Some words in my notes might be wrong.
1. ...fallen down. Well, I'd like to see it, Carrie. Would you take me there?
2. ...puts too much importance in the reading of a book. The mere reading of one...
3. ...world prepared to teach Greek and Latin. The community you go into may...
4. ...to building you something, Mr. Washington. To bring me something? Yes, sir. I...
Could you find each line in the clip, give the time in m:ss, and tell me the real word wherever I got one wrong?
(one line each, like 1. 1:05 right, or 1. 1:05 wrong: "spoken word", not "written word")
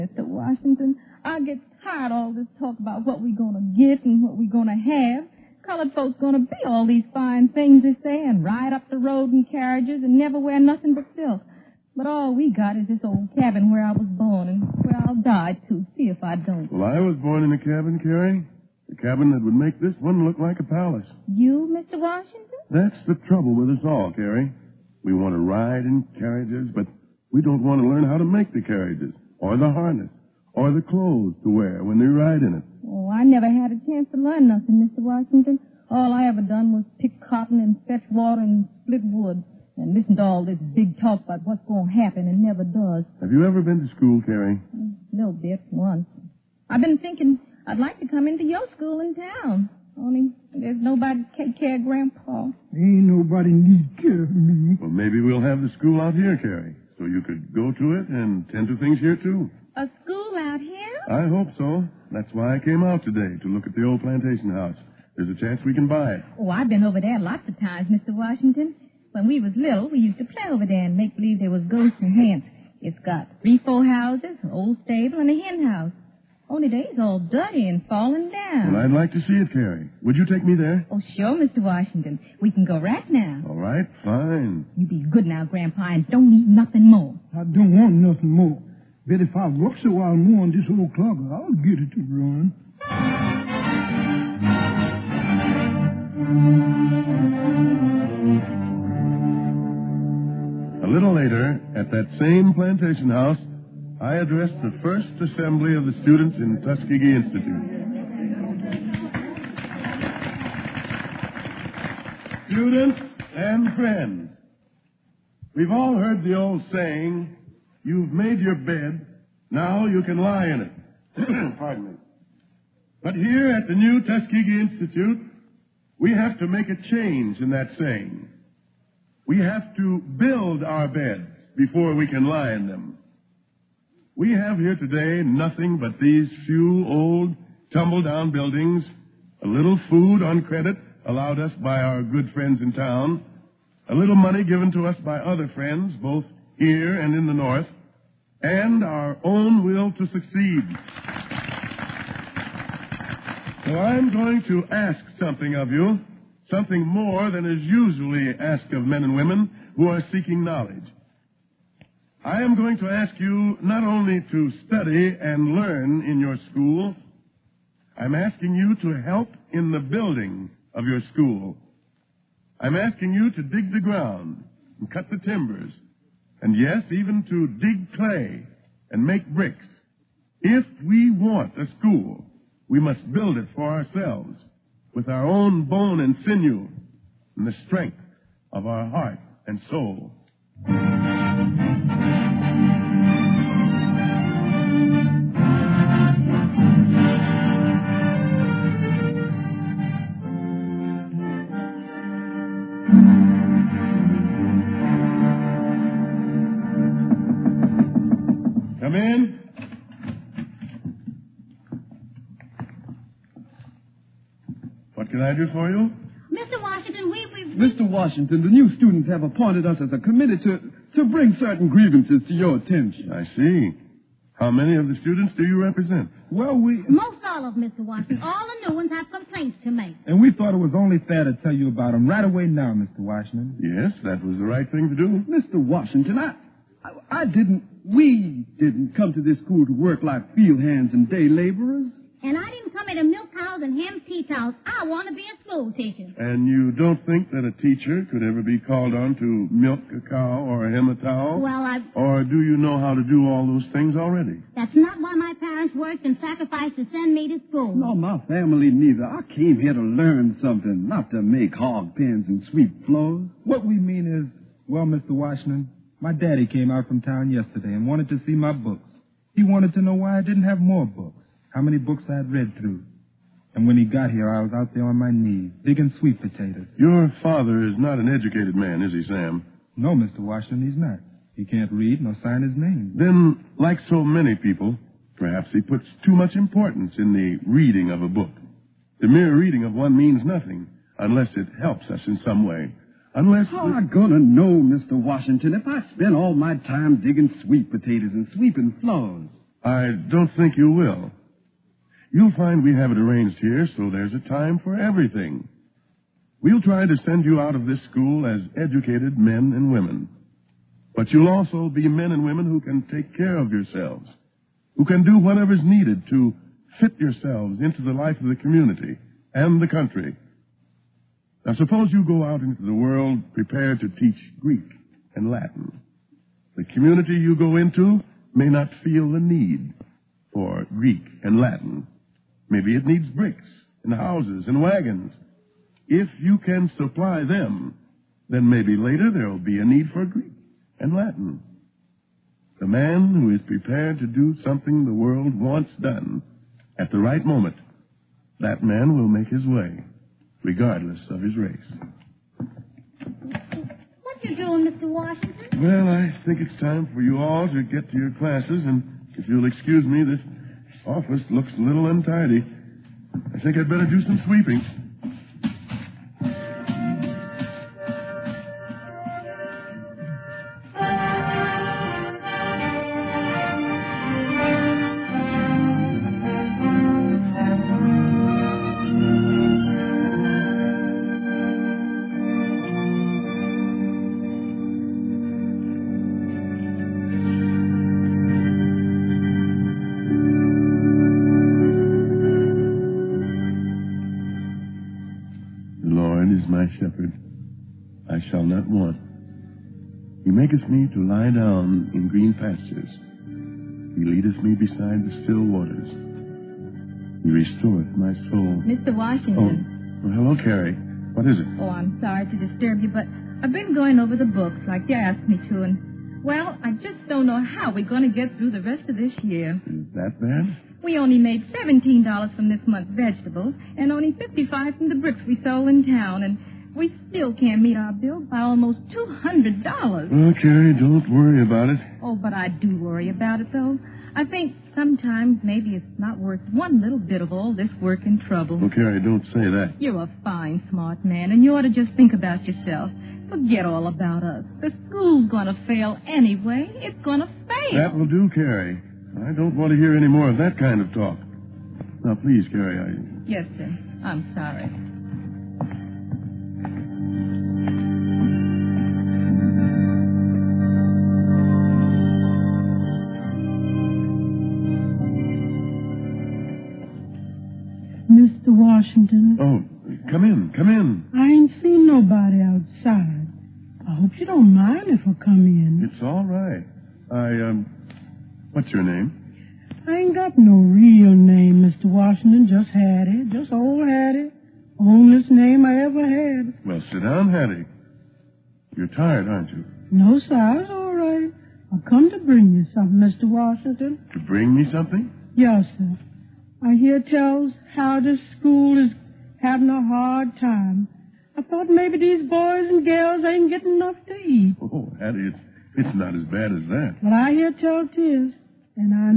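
1. 1:17 right
2. 4:45 right
3. 5:22 right
4. 8:12 wrong: "bring", not "building".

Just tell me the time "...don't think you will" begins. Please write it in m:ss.
5:00.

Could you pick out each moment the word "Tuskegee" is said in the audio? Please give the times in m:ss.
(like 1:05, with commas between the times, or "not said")
1:46, 2:04.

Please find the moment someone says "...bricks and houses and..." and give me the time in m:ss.
5:33.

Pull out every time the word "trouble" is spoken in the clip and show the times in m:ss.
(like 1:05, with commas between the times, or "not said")
0:23, 7:18.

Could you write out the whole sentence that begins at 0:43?
Have you ever been to school, Carrie?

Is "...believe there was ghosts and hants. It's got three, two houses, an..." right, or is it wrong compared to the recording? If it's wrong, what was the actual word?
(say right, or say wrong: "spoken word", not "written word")
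wrong: "four", not "two".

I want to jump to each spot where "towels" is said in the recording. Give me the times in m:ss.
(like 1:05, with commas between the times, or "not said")
4:04, 4:10.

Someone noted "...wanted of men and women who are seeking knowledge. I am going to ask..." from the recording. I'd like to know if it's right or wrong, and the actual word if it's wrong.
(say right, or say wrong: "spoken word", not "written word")
wrong: "asked", not "wanted".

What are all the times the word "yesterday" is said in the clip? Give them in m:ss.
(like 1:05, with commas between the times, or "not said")
4:27.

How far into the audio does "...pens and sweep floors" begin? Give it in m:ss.
4:21.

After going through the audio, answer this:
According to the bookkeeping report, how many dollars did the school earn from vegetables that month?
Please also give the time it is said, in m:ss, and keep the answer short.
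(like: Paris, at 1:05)
$17, at 7:01.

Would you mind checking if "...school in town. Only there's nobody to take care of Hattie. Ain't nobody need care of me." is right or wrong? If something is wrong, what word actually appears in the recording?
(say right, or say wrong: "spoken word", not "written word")
wrong: "Grandpa", not "Hattie".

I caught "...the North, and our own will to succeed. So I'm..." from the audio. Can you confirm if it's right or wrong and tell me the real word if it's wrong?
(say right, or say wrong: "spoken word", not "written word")
right.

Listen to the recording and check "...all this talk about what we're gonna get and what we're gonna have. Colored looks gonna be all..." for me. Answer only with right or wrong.
wrong.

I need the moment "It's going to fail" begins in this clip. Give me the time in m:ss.
7:26.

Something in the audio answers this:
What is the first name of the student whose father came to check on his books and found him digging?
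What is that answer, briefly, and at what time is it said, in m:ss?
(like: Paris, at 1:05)
Sam, at 4:39.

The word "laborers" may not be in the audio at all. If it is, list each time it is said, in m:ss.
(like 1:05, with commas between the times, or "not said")
4:01.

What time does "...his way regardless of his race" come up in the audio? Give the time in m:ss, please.
5:49.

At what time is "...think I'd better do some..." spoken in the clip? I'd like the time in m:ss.
6:03.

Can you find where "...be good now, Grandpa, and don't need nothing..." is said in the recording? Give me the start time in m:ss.
1:24.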